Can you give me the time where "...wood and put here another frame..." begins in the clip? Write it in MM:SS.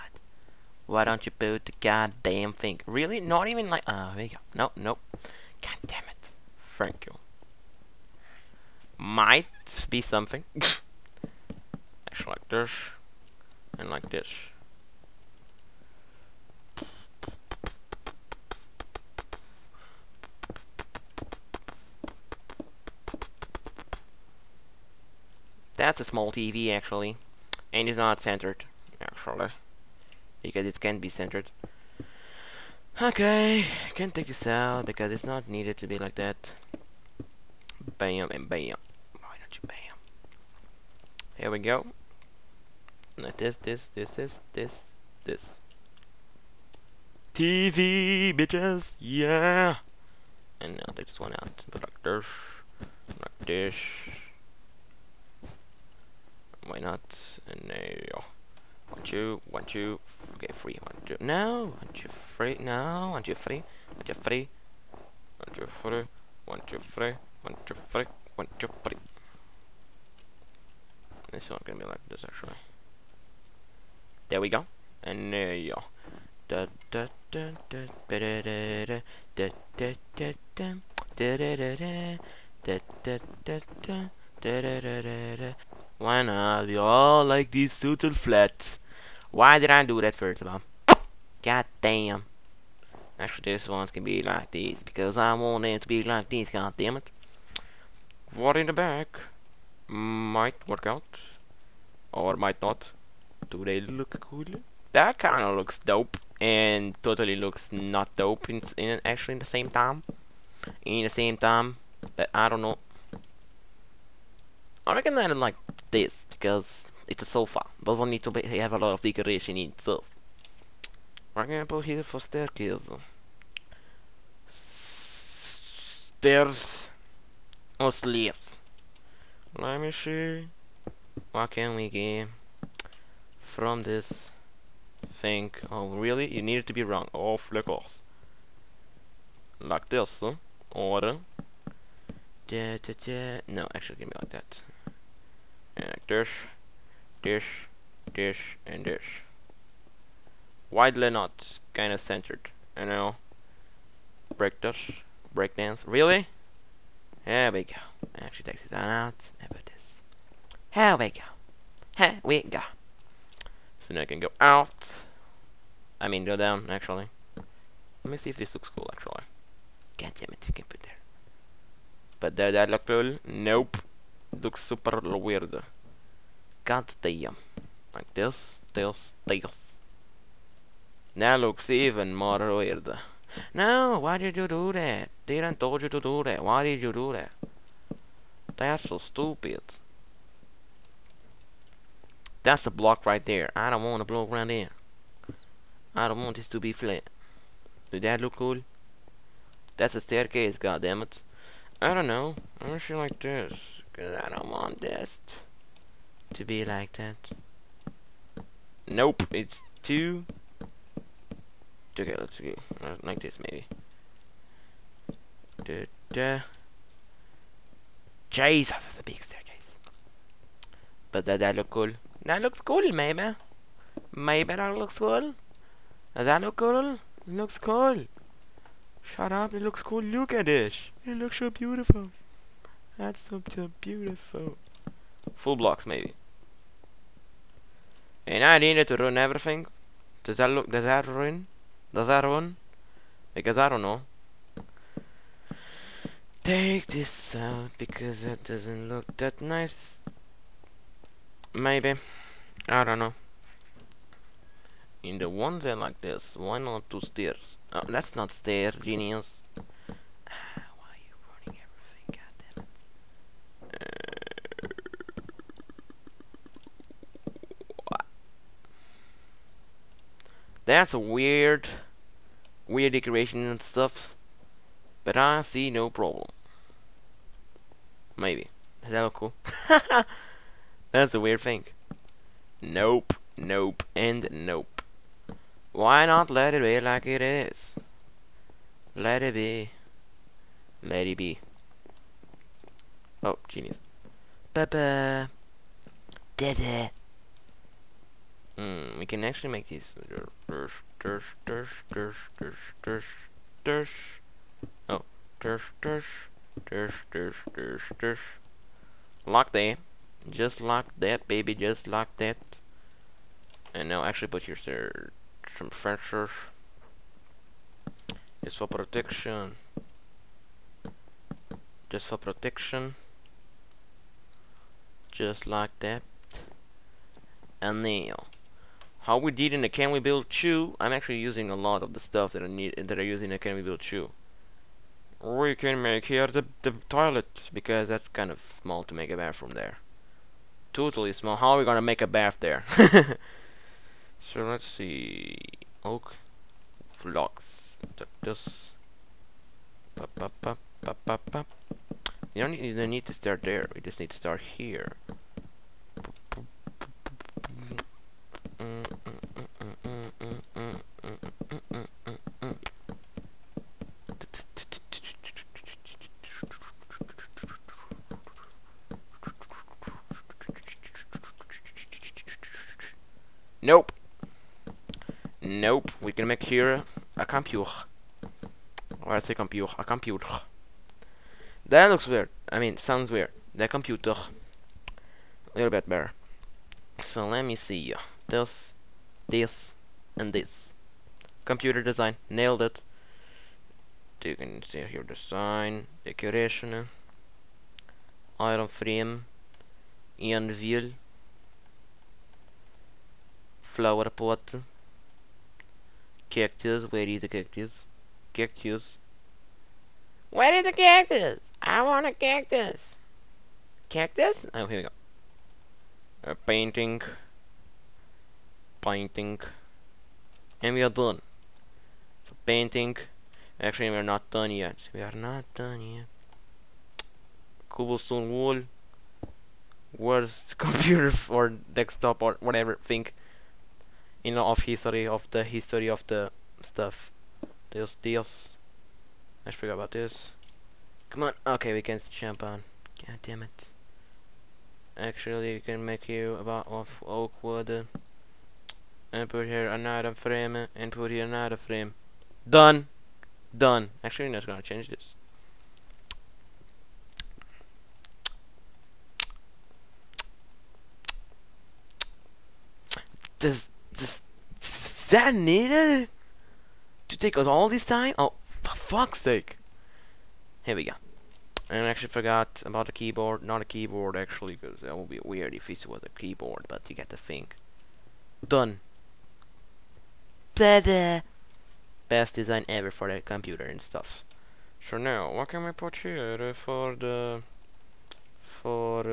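07:27.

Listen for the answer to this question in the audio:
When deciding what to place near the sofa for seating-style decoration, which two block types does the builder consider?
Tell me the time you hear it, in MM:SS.
02:06.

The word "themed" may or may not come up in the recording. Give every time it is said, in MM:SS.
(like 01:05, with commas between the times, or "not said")
not said.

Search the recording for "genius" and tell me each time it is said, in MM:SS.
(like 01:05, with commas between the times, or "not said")
04:18, 04:53.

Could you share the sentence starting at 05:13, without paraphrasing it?
And now actually put your some fences.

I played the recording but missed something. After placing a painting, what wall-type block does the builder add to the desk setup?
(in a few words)
Cobblestone wall.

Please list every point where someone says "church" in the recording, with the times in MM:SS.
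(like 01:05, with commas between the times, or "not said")
not said.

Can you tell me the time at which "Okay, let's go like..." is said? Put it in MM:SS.
03:31.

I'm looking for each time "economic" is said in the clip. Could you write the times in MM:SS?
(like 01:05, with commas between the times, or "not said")
not said.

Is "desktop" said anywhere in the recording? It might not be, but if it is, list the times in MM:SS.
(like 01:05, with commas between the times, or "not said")
07:11.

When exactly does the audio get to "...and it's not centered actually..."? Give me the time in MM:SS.
00:27.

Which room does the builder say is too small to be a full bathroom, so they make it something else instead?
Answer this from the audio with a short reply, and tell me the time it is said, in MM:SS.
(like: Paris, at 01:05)
the toilet, at 05:36.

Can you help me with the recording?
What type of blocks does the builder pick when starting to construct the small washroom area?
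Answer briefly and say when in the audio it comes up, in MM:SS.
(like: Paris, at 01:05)
Oak blocks, at 05:45.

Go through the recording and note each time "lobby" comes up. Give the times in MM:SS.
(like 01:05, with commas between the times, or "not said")
not said.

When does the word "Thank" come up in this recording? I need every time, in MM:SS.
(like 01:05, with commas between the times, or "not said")
00:06.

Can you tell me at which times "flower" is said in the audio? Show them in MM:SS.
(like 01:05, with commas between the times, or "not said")
06:43.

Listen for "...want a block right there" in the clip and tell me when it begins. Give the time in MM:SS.
03:13.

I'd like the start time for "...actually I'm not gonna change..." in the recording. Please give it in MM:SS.
07:34.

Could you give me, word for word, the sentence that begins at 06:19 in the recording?
Or I say computer, a computer.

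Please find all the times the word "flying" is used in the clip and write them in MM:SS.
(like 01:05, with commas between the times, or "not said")
not said.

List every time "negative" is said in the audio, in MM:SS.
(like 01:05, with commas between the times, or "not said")
not said.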